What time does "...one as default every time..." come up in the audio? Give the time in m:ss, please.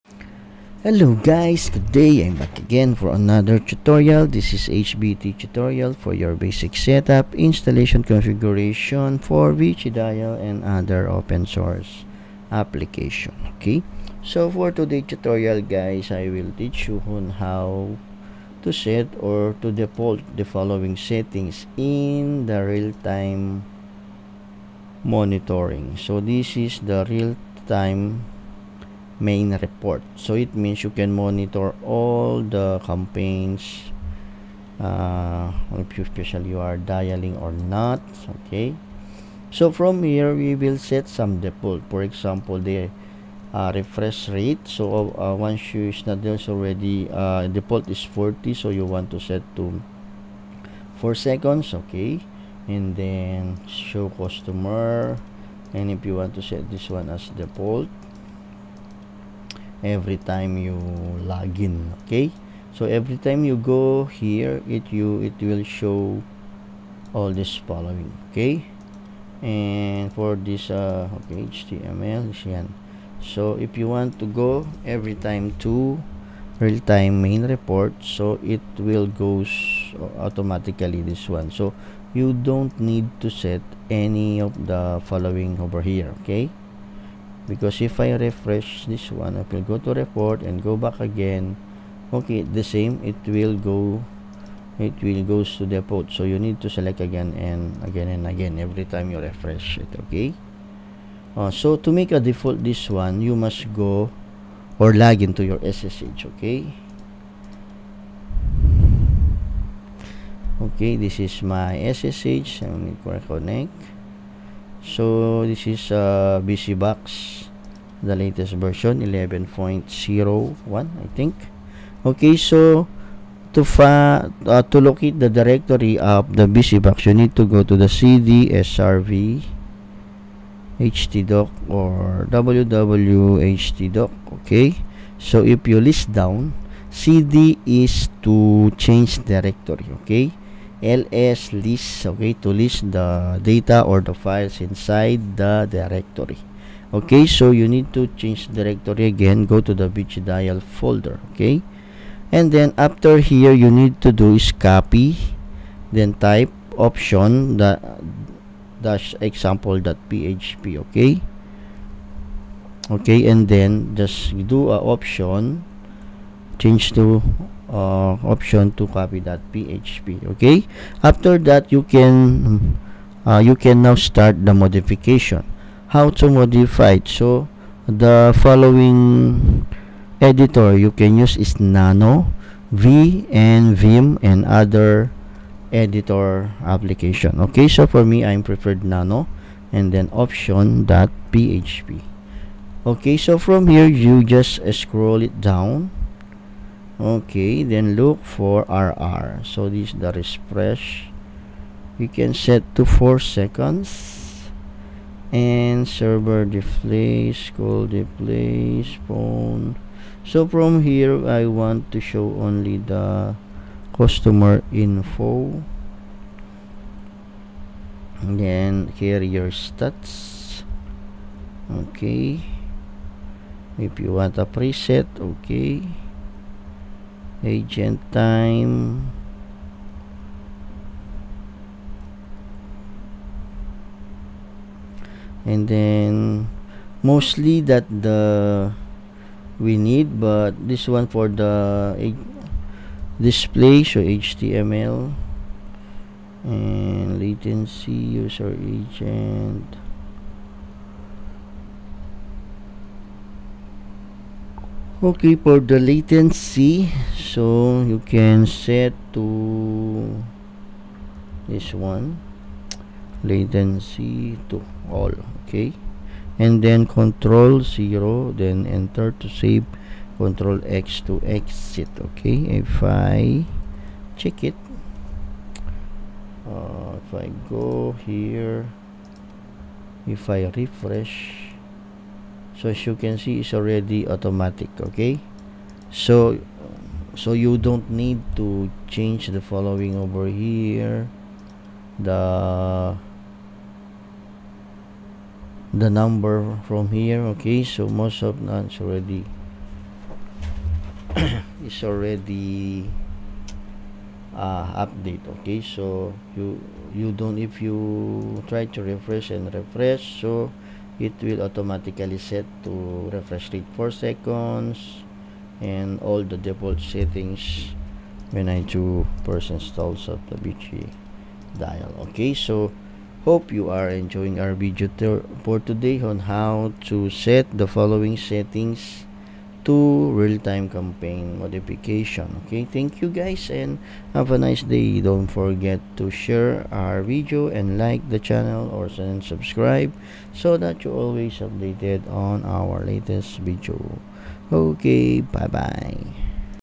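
0:56.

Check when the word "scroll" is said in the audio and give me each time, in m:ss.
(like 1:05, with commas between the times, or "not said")
3:14.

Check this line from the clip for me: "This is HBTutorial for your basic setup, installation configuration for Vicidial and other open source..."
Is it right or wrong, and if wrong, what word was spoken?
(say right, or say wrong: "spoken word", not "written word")
right.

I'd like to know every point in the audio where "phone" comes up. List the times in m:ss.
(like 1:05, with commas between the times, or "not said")
3:29.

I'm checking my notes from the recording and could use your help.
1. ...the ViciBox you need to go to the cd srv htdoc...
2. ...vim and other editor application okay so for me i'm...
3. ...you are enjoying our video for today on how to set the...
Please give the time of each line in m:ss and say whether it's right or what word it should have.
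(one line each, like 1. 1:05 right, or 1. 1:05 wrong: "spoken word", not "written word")
1. 2:06 right
2. 3:03 right
3. 5:23 right.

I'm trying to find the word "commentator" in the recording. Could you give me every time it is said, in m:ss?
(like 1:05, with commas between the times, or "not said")
not said.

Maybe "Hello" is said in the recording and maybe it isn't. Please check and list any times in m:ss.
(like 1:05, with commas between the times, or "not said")
0:00.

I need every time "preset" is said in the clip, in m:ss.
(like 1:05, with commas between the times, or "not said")
3:44.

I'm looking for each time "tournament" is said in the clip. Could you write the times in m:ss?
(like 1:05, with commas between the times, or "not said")
not said.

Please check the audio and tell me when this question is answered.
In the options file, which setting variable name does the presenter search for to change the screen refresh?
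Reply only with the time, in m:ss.
3:18.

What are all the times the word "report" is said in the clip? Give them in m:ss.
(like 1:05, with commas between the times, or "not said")
0:29, 1:17, 1:29.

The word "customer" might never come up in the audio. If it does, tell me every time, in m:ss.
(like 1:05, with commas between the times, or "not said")
0:54, 3:33.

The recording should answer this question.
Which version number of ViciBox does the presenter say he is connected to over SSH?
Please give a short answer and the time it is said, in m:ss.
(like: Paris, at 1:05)
11.01, at 1:58.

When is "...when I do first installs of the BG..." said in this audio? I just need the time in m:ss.
5:18.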